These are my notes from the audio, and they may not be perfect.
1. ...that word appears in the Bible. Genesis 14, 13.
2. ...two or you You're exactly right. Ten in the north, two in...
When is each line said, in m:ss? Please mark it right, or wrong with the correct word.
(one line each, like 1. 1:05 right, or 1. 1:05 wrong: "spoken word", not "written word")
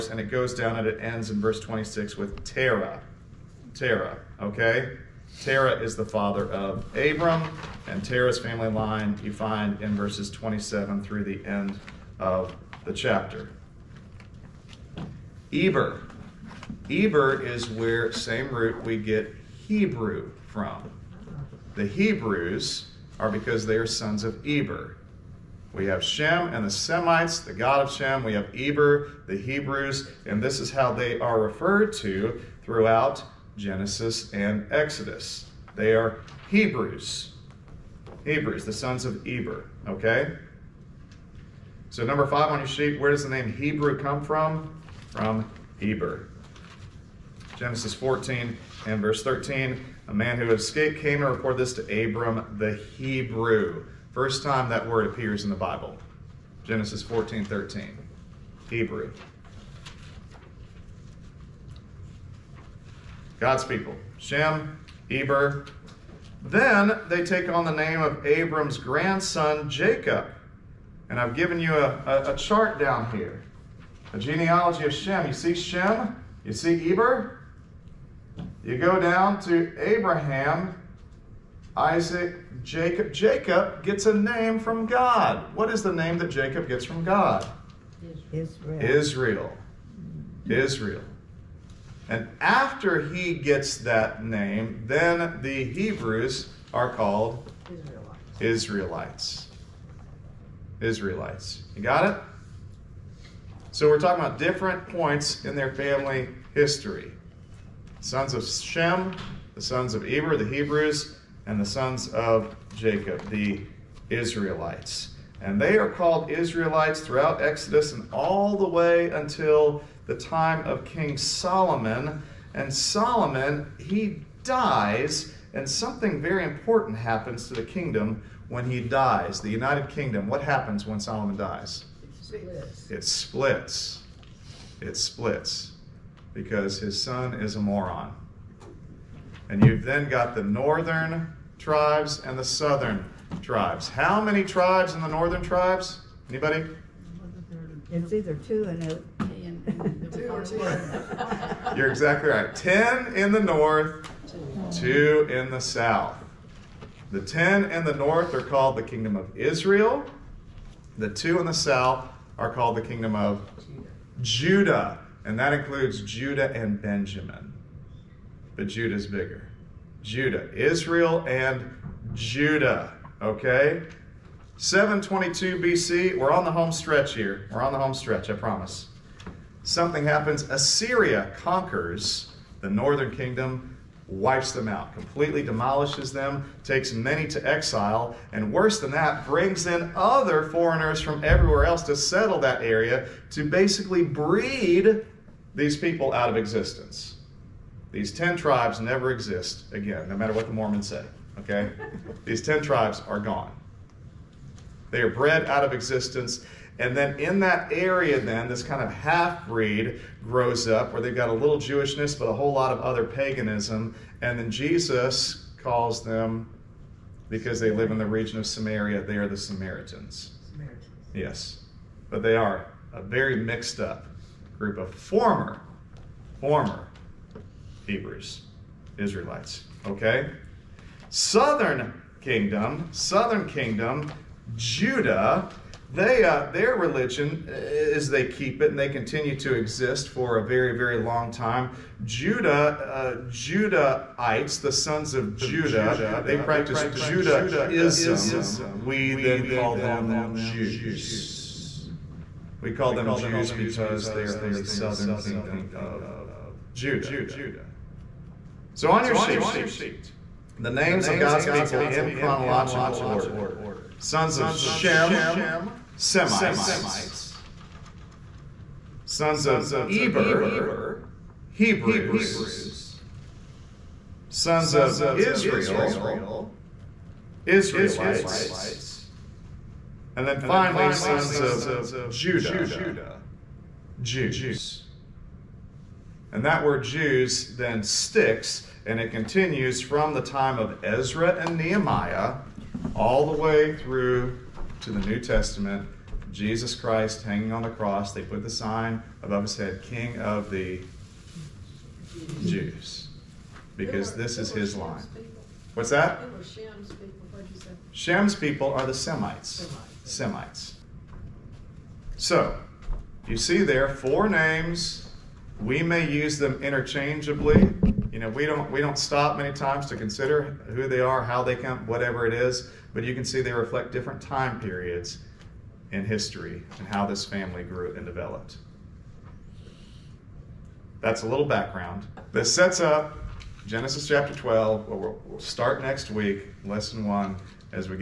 1. 0:54 right
2. 2:30 right.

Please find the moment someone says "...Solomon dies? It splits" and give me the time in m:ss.
2:10.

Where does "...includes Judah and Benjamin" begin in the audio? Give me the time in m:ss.
2:45.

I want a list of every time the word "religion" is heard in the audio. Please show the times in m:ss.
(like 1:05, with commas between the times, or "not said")
3:56.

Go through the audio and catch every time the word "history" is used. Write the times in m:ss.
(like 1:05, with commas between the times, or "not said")
1:46, 5:26.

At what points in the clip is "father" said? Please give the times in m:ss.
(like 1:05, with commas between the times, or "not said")
0:06.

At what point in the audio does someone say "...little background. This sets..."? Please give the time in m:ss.
5:31.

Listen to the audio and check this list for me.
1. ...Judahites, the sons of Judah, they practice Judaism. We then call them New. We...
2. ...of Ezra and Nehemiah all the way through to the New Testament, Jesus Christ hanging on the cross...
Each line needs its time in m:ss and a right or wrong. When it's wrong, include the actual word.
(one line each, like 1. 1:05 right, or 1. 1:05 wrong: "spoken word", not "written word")
1. 4:03 wrong: "Jews", not "New"
2. 4:50 right.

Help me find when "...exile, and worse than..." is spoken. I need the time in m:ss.
3:07.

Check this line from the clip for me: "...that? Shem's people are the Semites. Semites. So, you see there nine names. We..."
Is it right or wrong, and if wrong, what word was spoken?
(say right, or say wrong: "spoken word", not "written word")
wrong: "four", not "nine".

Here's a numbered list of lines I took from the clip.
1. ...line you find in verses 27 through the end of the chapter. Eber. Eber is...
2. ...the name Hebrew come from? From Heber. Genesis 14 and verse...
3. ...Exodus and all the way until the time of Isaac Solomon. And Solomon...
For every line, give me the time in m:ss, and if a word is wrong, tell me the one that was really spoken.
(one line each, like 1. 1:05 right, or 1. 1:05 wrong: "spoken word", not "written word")
1. 0:08 right
2. 0:43 right
3. 1:57 wrong: "King", not "Isaac".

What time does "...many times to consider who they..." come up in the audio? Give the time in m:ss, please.
5:19.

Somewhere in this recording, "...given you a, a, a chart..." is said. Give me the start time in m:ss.
1:11.